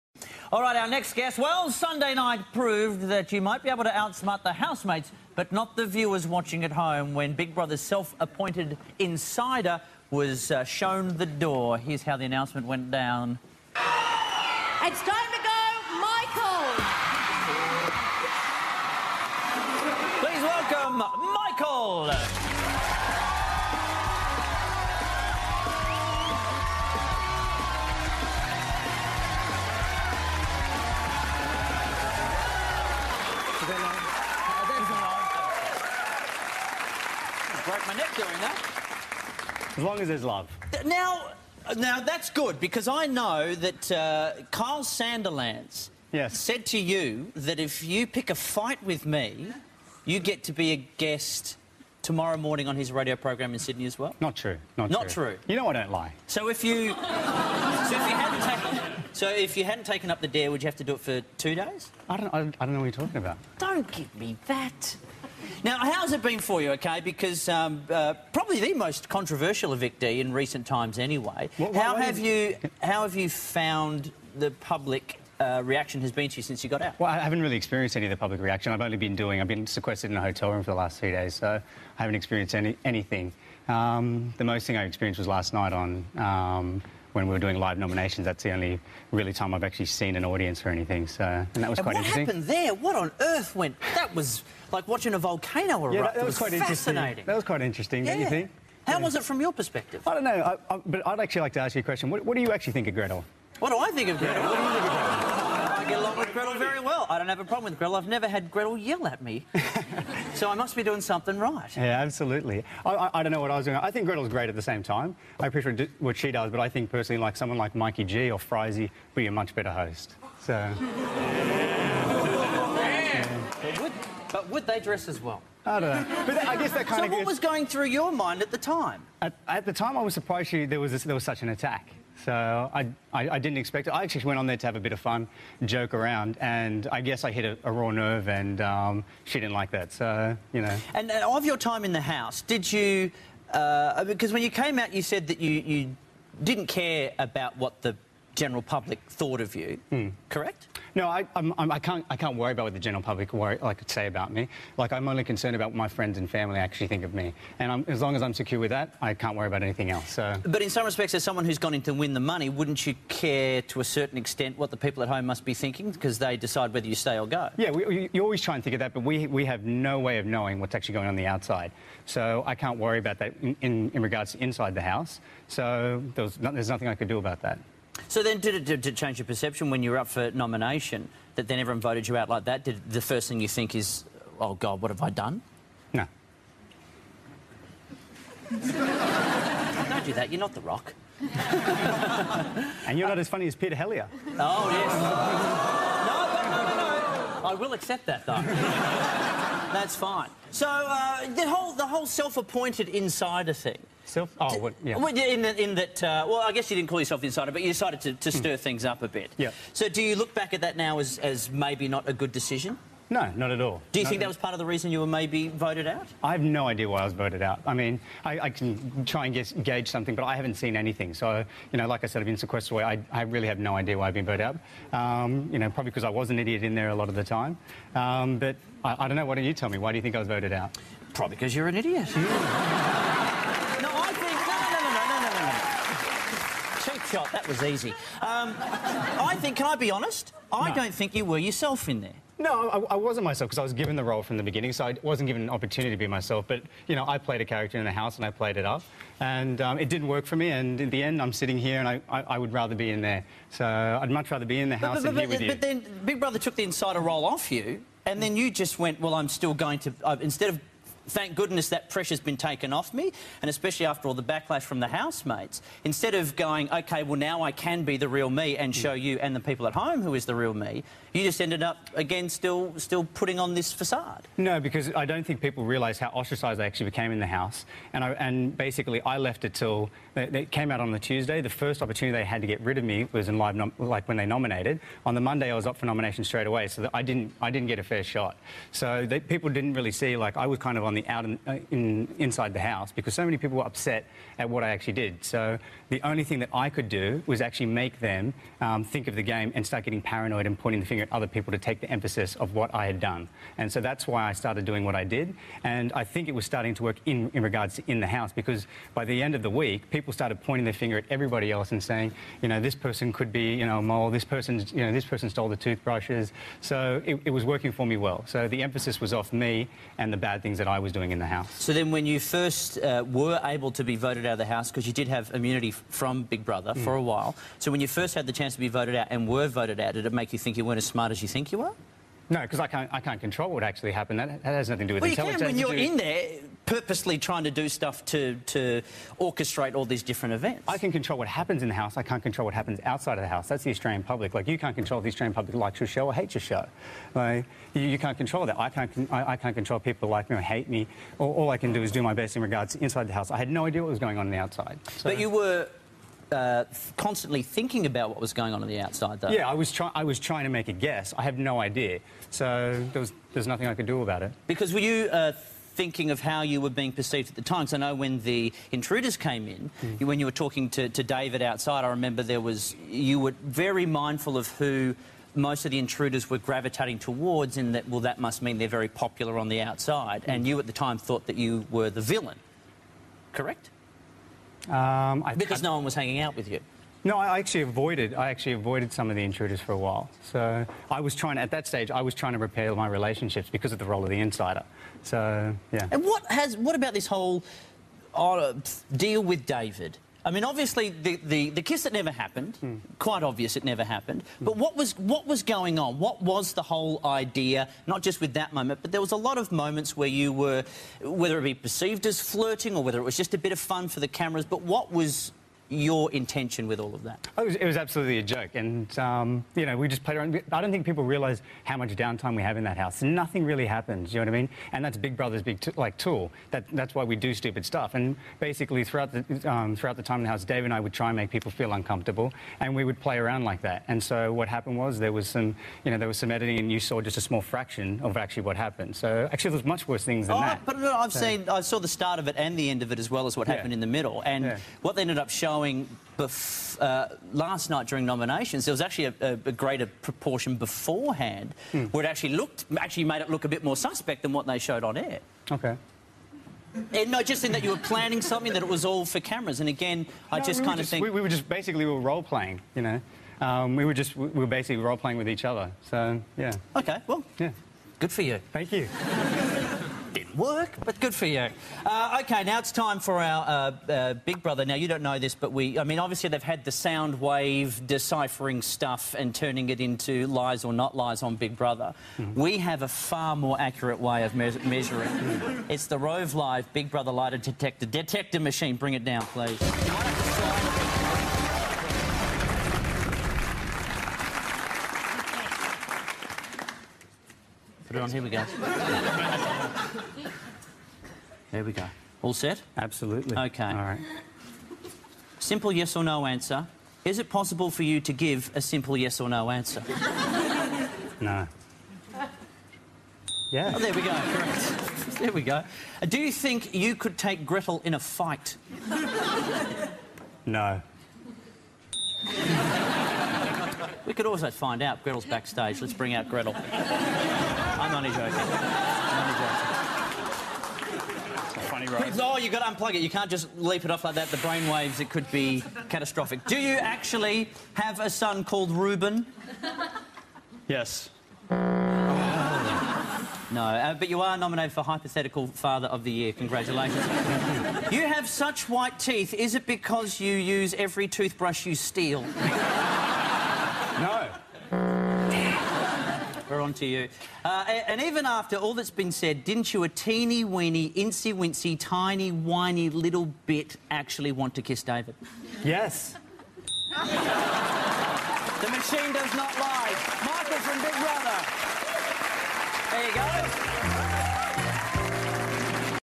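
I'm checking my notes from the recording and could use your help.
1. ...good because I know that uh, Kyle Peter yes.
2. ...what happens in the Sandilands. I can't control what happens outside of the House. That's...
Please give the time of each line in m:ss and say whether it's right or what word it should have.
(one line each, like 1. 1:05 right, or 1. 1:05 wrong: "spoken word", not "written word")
1. 0:42 wrong: "Sandilands", not "Peter"
2. 5:41 wrong: "House", not "Sandilands".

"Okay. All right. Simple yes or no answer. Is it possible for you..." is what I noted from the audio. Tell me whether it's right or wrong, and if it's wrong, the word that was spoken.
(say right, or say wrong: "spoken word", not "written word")
right.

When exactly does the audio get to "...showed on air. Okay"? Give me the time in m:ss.
7:34.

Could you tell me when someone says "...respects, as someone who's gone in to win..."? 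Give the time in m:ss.
2:40.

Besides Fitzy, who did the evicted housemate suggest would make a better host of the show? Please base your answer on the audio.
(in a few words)
Mikey G.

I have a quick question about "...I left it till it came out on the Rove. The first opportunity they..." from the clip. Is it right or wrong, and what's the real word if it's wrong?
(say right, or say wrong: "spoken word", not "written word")
wrong: "Tuesday", not "Rove".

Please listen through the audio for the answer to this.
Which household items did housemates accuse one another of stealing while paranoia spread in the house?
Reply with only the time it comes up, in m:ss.
5:15.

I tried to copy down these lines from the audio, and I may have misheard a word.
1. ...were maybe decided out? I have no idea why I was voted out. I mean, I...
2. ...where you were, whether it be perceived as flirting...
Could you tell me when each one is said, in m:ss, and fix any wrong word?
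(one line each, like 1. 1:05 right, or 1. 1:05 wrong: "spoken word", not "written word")
1. 3:35 wrong: "voted", not "decided"
2. 6:49 right.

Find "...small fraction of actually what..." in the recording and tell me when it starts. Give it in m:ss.
7:17.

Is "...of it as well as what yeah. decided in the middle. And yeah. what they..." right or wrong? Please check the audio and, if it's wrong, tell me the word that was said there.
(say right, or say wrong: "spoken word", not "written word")
wrong: "happened", not "decided".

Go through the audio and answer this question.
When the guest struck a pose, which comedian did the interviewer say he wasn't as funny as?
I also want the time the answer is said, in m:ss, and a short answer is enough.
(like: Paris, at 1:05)
Peter Hellier, at 3:13.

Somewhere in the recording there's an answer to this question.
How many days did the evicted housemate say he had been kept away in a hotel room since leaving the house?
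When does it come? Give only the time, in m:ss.
1:20.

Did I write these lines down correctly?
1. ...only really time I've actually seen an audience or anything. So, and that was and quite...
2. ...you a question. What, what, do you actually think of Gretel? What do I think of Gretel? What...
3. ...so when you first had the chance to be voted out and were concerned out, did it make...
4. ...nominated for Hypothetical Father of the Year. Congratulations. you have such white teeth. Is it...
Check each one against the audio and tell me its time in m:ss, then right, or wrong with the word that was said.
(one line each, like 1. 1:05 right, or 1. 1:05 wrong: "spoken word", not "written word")
1. 1:28 right
2. 1:41 right
3. 5:27 wrong: "voted", not "concerned"
4. 9:04 right.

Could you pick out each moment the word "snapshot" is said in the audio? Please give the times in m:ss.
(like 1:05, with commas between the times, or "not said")
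not said.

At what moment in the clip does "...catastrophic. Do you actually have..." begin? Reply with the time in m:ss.
8:55.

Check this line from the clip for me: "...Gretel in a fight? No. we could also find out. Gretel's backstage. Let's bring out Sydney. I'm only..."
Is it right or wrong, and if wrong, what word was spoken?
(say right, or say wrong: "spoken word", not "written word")
wrong: "Gretel", not "Sydney".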